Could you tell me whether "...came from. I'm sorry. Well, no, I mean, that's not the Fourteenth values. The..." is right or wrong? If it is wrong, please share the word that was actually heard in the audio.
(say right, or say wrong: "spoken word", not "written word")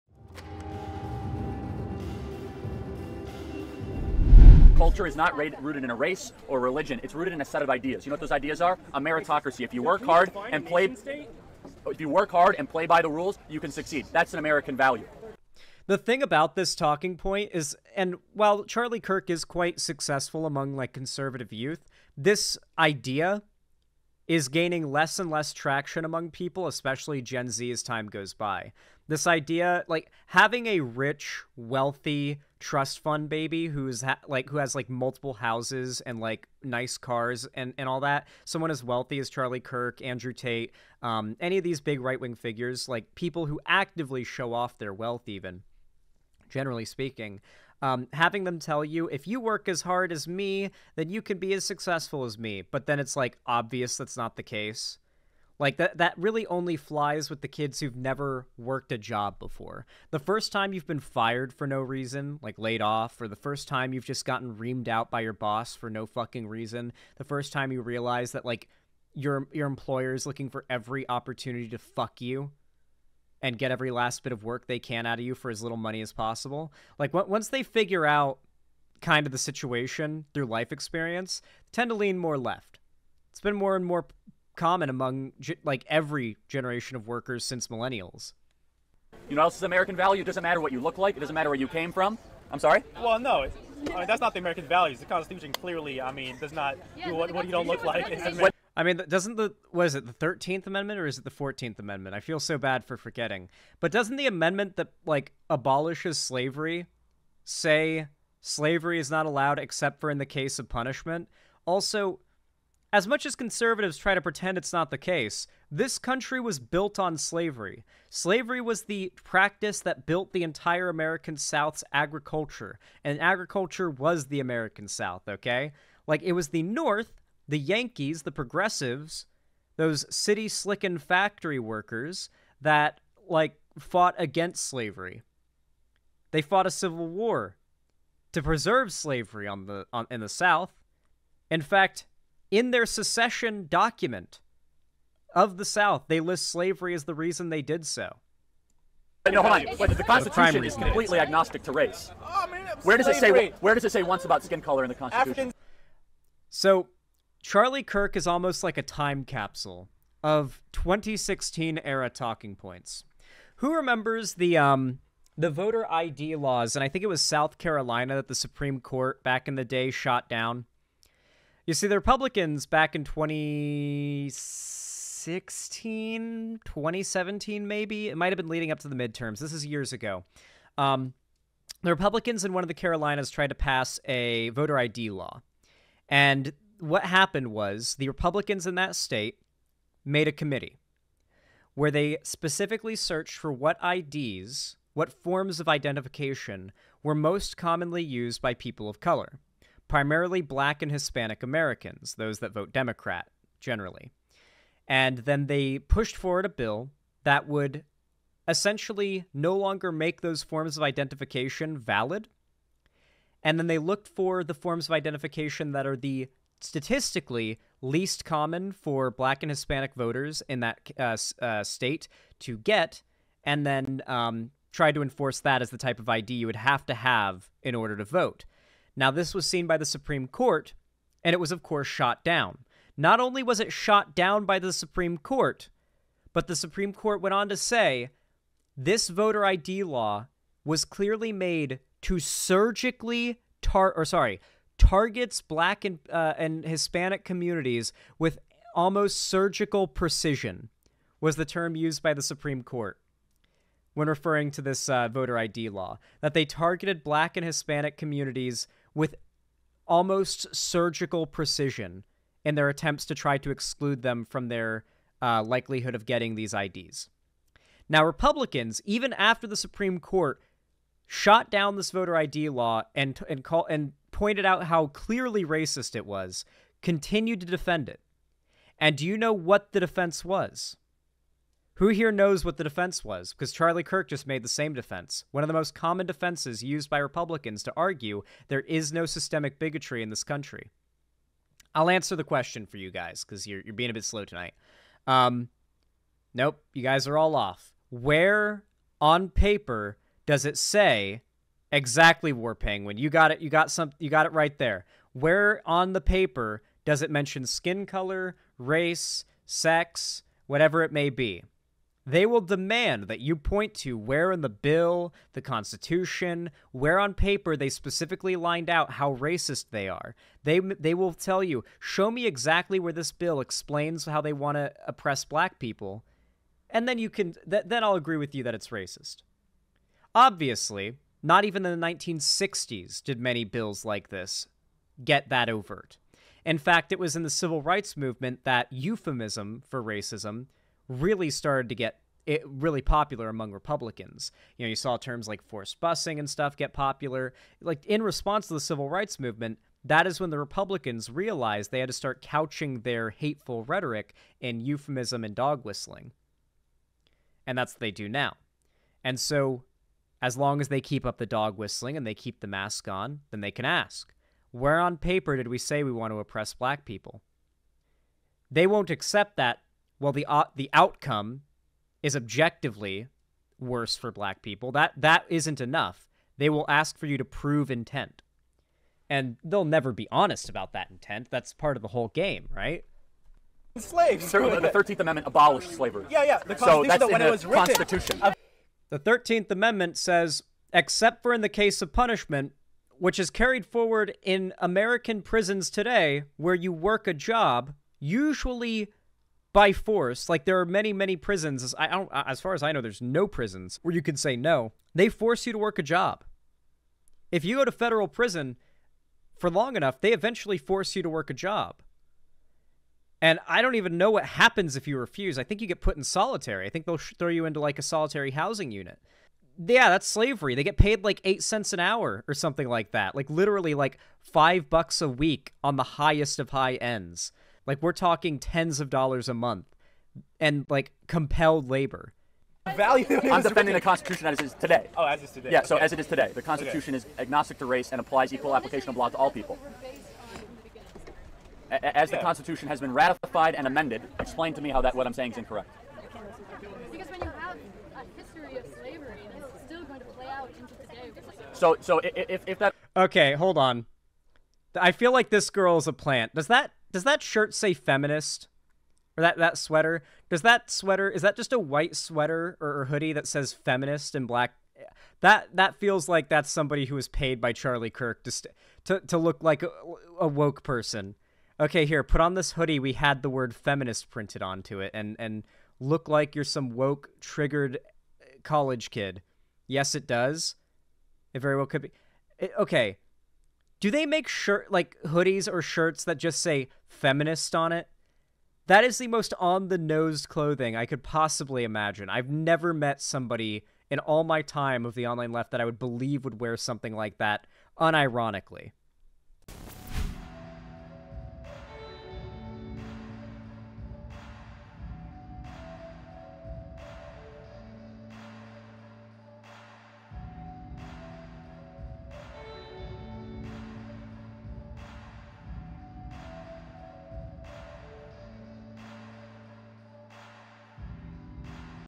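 wrong: "American", not "Fourteenth".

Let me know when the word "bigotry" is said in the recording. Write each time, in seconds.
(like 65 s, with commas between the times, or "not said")
289 s.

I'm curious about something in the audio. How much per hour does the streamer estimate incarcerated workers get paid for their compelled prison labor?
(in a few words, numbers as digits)
8 cents.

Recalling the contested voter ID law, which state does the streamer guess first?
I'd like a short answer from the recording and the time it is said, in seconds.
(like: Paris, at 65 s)
South Carolina, at 167 s.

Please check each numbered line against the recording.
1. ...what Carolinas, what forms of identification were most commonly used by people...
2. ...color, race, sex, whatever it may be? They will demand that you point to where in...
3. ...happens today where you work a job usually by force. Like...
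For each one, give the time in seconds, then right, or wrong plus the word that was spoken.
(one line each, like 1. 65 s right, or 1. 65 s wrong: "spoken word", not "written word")
1. 193 s wrong: "IDs", not "Carolinas"
2. 307 s right
3. 395 s wrong: "prisons", not "happens".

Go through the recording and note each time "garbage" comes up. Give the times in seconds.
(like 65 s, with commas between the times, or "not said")
not said.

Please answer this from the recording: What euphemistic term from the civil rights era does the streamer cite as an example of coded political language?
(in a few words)
forced busing.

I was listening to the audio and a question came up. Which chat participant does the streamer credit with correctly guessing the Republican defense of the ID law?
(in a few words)
War Penguin.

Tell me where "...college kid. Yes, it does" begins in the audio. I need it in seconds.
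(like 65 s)
478 s.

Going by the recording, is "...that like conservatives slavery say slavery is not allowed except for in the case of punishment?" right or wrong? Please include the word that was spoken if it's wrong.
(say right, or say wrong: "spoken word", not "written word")
wrong: "abolishes", not "conservatives".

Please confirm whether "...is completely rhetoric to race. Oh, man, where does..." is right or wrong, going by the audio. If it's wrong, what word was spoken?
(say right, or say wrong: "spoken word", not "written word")
wrong: "agnostic", not "rhetoric".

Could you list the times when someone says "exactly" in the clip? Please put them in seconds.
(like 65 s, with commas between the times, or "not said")
301 s, 322 s.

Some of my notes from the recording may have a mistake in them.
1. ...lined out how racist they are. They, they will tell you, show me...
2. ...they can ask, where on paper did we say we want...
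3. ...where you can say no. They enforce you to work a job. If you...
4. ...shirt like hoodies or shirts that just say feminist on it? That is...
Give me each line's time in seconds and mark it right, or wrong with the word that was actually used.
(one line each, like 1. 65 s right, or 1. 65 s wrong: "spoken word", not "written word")
1. 318 s right
2. 363 s right
3. 403 s wrong: "force", not "enforce"
4. 484 s right.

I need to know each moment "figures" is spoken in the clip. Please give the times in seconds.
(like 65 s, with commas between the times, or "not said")
42 s, 77 s.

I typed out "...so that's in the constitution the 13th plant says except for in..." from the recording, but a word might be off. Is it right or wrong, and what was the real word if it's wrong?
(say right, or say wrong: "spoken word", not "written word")
wrong: "amendment", not "plant".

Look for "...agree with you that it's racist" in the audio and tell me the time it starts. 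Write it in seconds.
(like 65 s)
327 s.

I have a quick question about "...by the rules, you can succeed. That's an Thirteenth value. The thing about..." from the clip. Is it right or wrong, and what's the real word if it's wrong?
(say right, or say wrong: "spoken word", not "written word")
wrong: "American", not "Thirteenth".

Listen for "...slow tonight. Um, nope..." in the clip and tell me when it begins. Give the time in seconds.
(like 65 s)
294 s.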